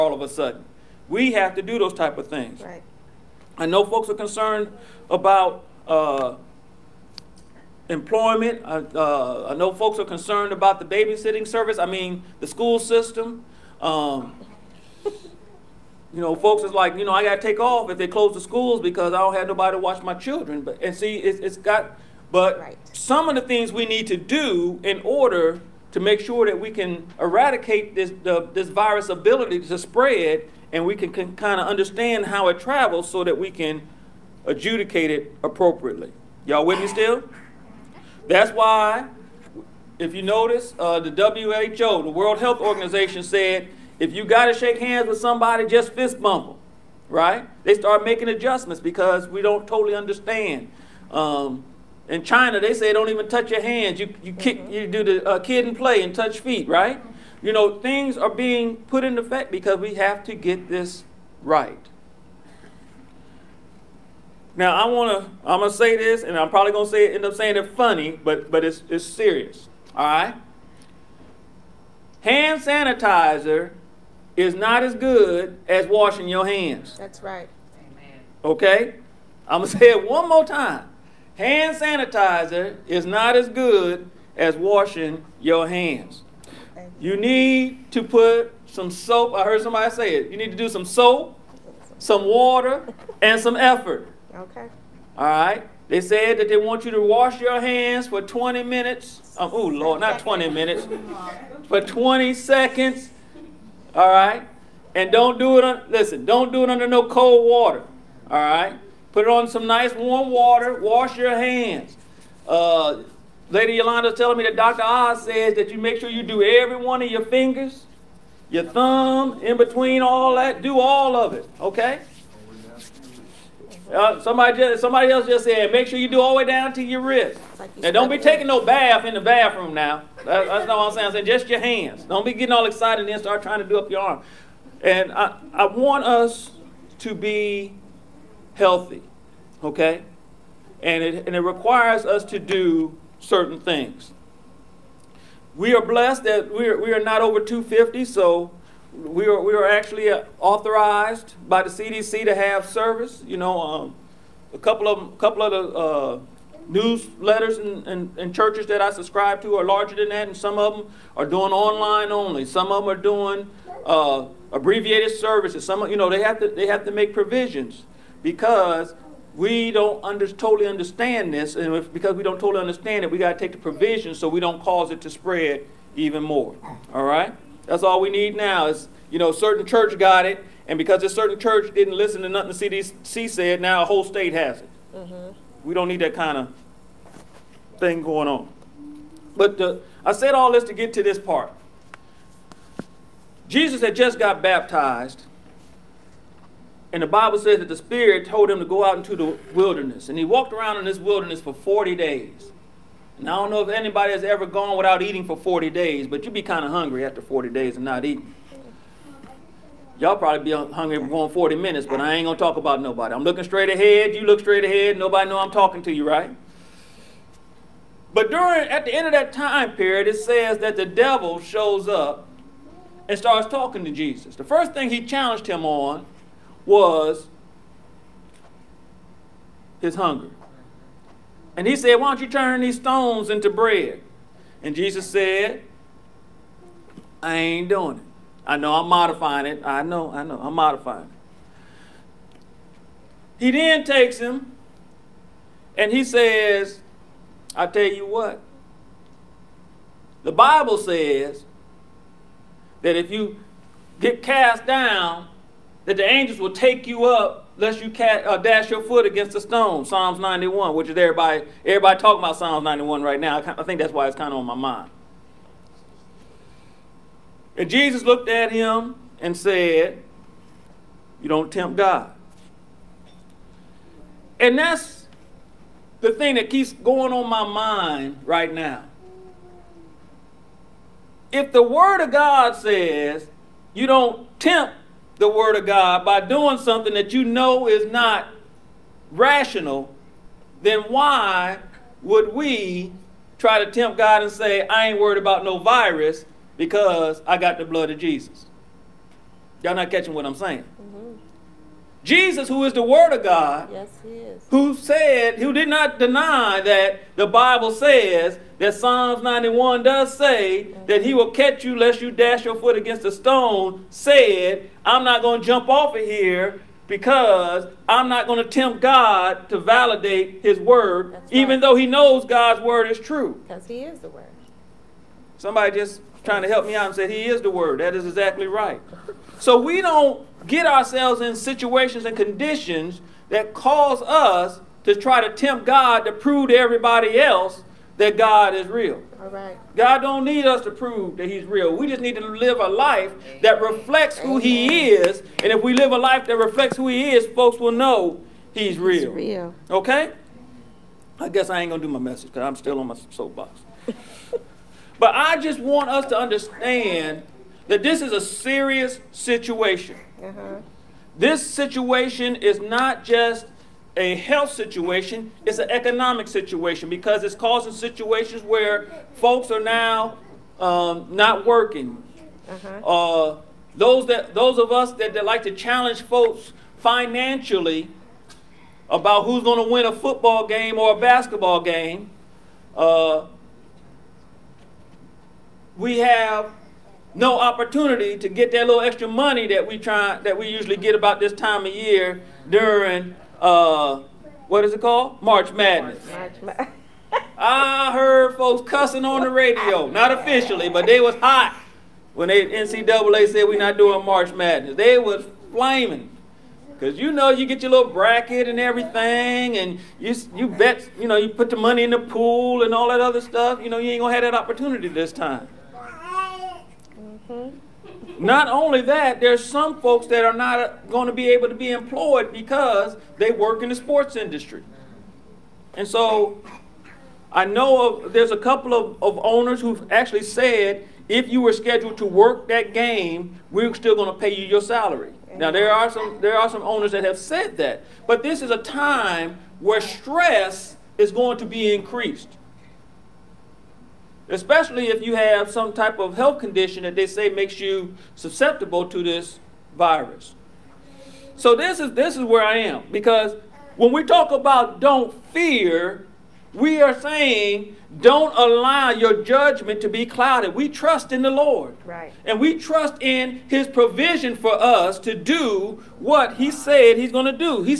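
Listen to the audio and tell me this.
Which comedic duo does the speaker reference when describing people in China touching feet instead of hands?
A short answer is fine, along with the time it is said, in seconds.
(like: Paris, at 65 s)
Kid 'n Play, at 55 s.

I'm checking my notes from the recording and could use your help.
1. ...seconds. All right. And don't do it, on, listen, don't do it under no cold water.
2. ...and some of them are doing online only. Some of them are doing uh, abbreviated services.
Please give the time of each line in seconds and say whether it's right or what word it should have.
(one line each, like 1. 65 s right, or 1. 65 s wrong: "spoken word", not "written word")
1. 102 s right
2. 160 s right.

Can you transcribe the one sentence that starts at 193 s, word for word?
Jesus had just got baptized, and the Bible says that the Spirit told him to go out into the wilderness.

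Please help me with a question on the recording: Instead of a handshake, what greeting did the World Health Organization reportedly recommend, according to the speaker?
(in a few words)
fist bump.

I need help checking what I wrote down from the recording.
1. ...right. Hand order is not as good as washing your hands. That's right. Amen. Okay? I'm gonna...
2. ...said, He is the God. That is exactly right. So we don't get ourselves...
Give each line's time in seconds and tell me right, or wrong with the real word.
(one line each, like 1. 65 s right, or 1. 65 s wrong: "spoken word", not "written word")
1. 70 s wrong: "sanitizer", not "order"
2. 326 s wrong: "Word", not "God".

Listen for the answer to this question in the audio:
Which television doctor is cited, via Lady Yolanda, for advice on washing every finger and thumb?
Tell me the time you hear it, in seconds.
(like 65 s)
114 s.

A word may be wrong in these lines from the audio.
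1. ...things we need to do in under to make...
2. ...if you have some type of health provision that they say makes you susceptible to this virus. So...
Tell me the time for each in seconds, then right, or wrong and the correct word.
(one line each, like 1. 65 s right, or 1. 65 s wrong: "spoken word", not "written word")
1. 23 s wrong: "order", not "under"
2. 444 s wrong: "condition", not "provision".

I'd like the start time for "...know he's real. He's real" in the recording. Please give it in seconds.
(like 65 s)
347 s.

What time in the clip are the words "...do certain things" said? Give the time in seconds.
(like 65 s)
142 s.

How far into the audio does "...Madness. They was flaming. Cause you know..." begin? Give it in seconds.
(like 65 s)
404 s.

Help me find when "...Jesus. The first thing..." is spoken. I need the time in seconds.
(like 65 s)
223 s.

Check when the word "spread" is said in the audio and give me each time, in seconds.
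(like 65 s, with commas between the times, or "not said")
29 s, 175 s.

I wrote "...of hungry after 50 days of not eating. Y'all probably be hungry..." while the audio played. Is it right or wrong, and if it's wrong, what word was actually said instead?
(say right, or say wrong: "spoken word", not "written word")
wrong: "40", not "50".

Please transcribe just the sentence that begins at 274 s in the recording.
And that's the thing that keeps going on my mind right now.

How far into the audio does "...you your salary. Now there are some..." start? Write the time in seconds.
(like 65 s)
434 s.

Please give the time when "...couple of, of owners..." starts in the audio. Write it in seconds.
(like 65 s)
428 s.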